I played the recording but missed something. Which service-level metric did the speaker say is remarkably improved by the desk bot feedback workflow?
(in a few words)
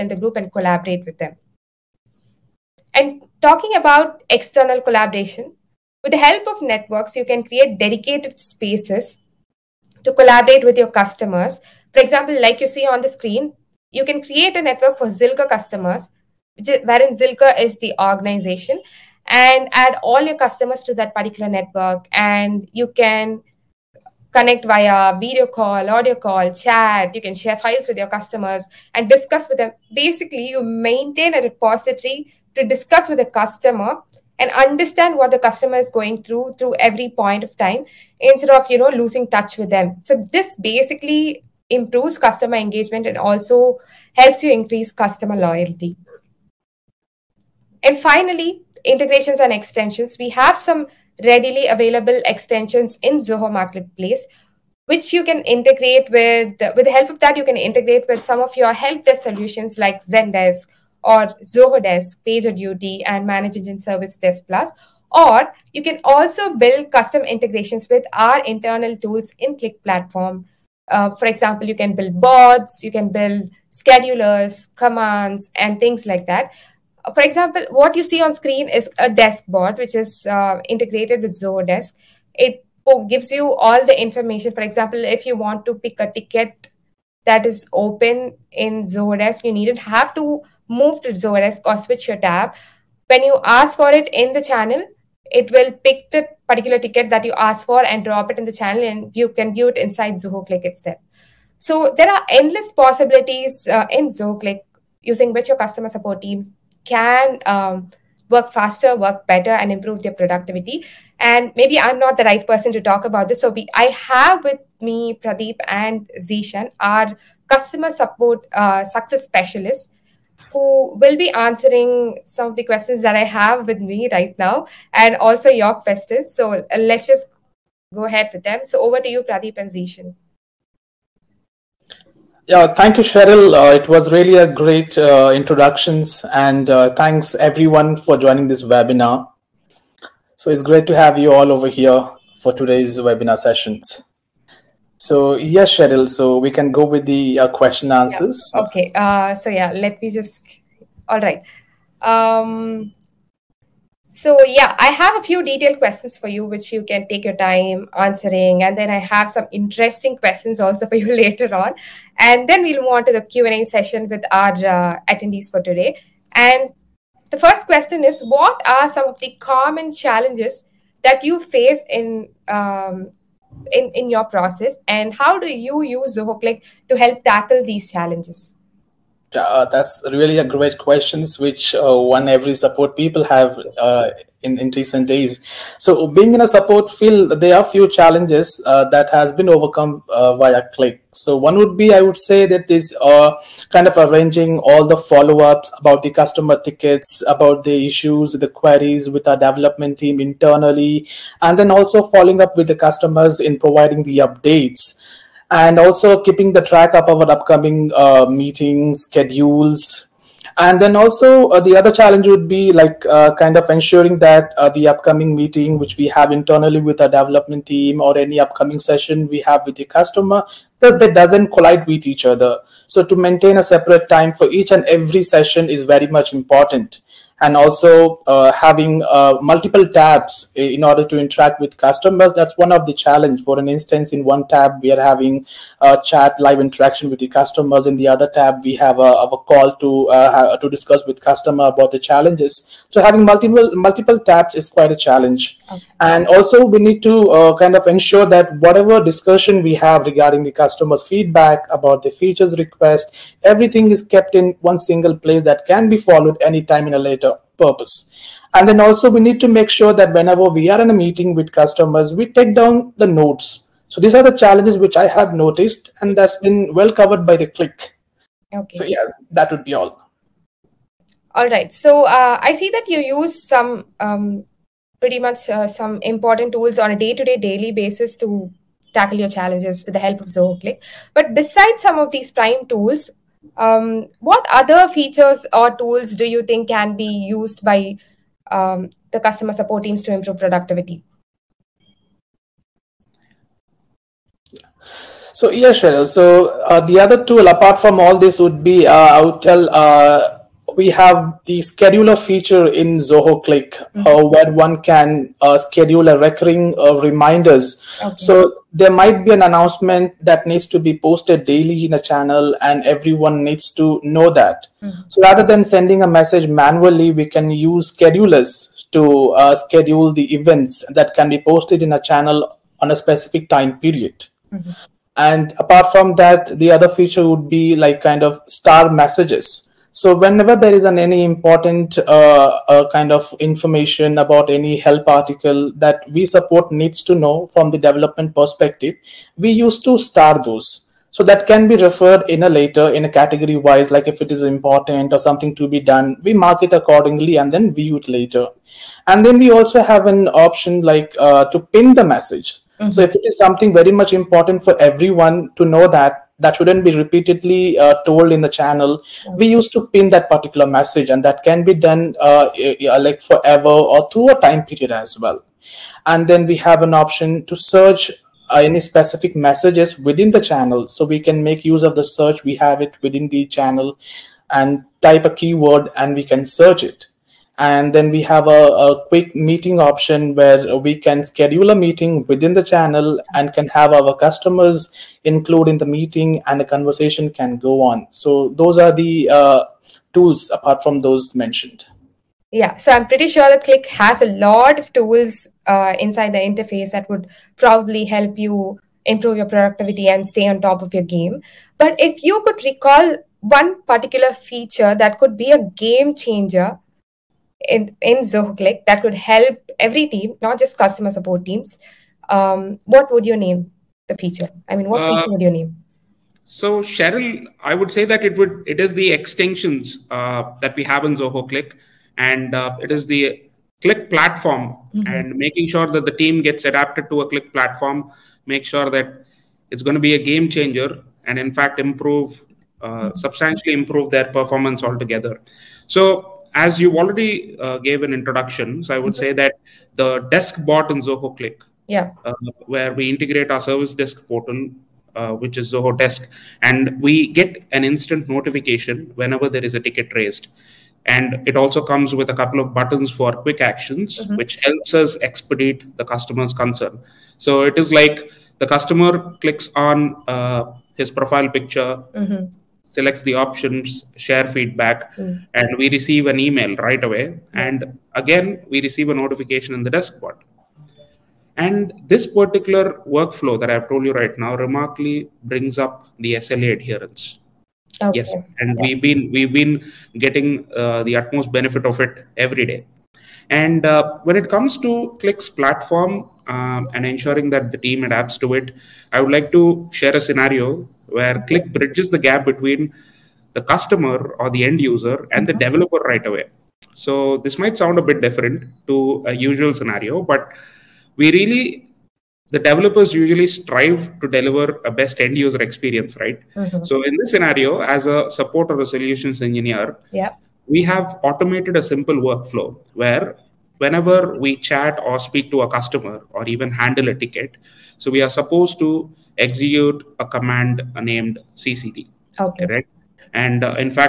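SLA adherence.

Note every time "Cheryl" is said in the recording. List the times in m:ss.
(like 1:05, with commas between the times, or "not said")
2:13, 2:25, 4:55, 6:56.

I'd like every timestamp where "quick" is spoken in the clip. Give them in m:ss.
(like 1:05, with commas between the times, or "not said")
6:19, 7:33.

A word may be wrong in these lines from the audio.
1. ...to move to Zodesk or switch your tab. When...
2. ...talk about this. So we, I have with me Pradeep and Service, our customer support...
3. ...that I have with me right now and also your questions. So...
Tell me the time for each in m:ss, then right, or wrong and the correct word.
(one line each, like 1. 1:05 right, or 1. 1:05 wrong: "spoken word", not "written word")
1. 1:30 right
2. 1:52 wrong: "Zishan", not "Service"
3. 2:03 right.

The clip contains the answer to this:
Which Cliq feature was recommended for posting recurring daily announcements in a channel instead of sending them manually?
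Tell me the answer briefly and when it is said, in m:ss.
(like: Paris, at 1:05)
Scheduler, at 5:01.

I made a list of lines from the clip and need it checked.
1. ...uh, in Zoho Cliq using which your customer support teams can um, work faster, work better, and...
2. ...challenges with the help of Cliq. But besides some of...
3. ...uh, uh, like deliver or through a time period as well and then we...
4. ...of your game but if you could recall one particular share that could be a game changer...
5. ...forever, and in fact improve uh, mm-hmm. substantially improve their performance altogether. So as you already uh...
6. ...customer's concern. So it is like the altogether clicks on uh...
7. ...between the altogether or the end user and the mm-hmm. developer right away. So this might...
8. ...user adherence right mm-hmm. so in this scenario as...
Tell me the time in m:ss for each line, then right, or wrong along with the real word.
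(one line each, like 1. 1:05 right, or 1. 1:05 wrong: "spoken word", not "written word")
1. 1:43 right
2. 4:39 right
3. 6:02 wrong: "forever", not "deliver"
4. 6:40 wrong: "feature", not "share"
5. 7:10 wrong: "changer", not "forever"
6. 7:36 wrong: "customer", not "altogether"
7. 8:12 wrong: "customer", not "altogether"
8. 8:25 wrong: "experience", not "adherence".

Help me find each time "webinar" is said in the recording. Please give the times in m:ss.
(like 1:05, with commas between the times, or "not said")
2:18, 2:22.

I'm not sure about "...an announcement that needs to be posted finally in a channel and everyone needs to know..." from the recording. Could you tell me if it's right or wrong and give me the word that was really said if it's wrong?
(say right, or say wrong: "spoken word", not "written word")
wrong: "daily", not "finally".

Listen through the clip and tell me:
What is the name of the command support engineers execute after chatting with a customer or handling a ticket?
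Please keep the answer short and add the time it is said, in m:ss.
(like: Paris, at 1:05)
CCD, at 8:41.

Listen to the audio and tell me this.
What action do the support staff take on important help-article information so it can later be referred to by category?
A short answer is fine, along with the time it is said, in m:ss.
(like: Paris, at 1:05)
Star messages, at 5:28.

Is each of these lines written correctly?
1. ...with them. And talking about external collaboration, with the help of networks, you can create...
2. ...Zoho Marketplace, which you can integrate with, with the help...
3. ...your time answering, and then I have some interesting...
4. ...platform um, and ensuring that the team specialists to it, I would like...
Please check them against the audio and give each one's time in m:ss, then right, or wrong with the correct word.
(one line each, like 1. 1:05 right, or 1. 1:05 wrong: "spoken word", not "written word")
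1. 0:01 right
2. 0:53 right
3. 2:37 right
4. 8:05 wrong: "adapts", not "specialists".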